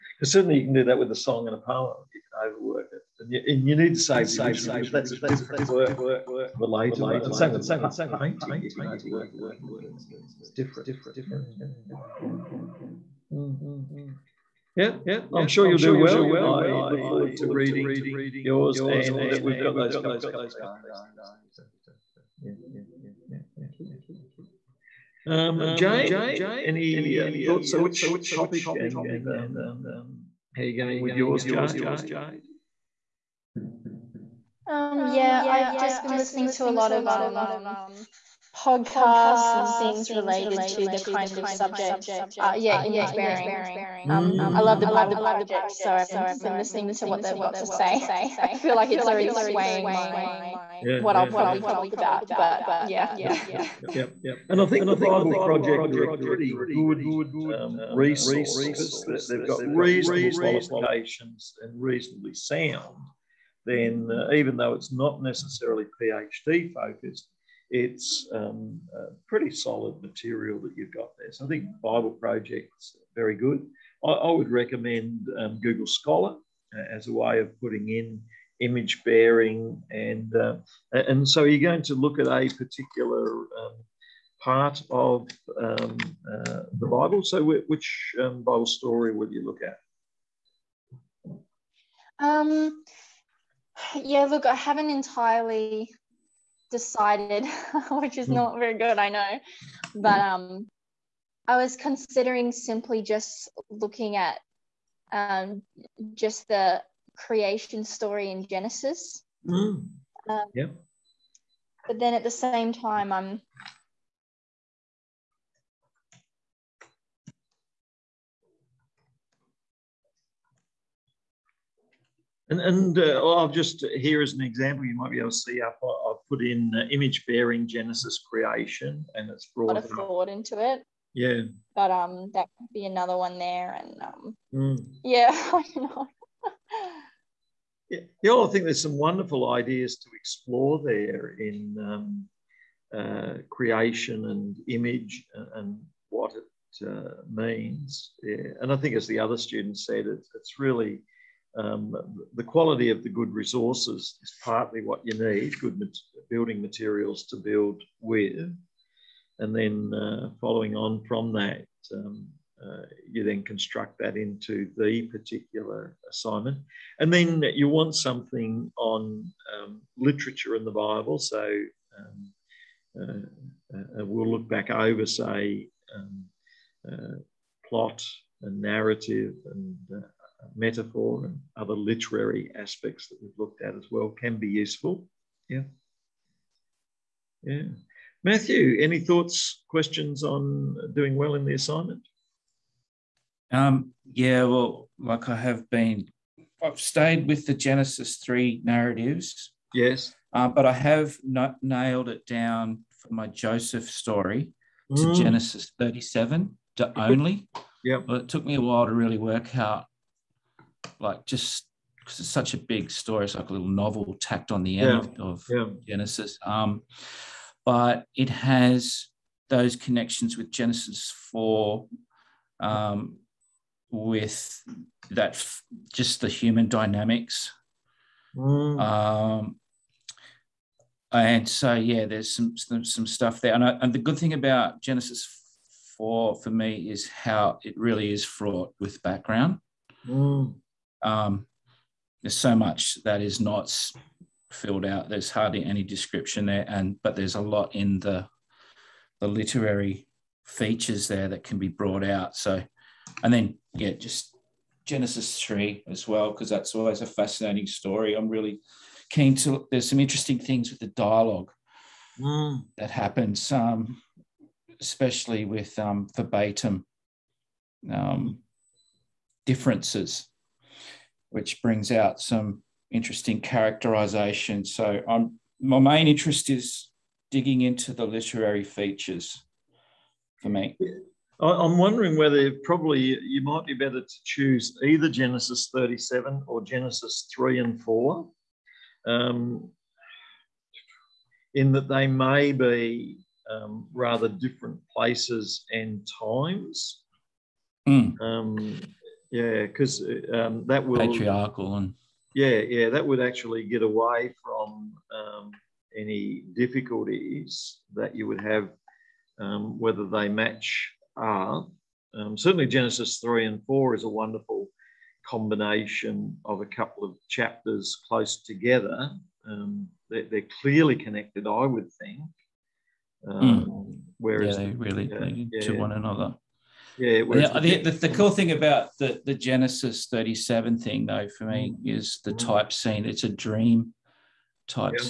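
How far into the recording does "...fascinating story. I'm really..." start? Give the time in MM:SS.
04:17.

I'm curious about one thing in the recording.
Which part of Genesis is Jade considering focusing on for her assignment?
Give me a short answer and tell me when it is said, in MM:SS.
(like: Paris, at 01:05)
The creation story, at 01:47.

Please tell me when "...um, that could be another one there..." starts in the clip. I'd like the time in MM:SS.
02:11.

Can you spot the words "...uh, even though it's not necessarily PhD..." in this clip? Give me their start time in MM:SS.
01:04.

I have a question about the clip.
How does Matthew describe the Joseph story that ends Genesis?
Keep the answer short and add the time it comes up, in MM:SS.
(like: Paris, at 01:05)
A little novel, at 03:33.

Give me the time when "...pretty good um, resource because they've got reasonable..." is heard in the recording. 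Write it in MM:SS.
00:56.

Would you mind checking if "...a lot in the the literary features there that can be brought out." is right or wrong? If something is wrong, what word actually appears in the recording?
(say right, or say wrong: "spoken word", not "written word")
right.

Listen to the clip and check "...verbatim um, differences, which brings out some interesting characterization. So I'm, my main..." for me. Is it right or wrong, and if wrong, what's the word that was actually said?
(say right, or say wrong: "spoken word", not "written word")
right.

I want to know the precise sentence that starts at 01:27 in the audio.
So, which um, Bible story would you look at?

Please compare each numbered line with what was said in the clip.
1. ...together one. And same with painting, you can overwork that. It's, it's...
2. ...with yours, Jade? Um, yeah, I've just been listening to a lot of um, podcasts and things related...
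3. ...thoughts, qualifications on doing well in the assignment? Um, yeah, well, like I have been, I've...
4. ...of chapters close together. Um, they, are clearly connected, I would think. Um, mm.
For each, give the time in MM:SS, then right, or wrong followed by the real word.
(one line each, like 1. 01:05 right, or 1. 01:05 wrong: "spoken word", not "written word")
1. 00:06 wrong: "later", not "together"
2. 00:31 right
3. 03:09 wrong: "questions", not "qualifications"
4. 05:17 right.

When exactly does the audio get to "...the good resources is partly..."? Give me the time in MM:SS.
02:33.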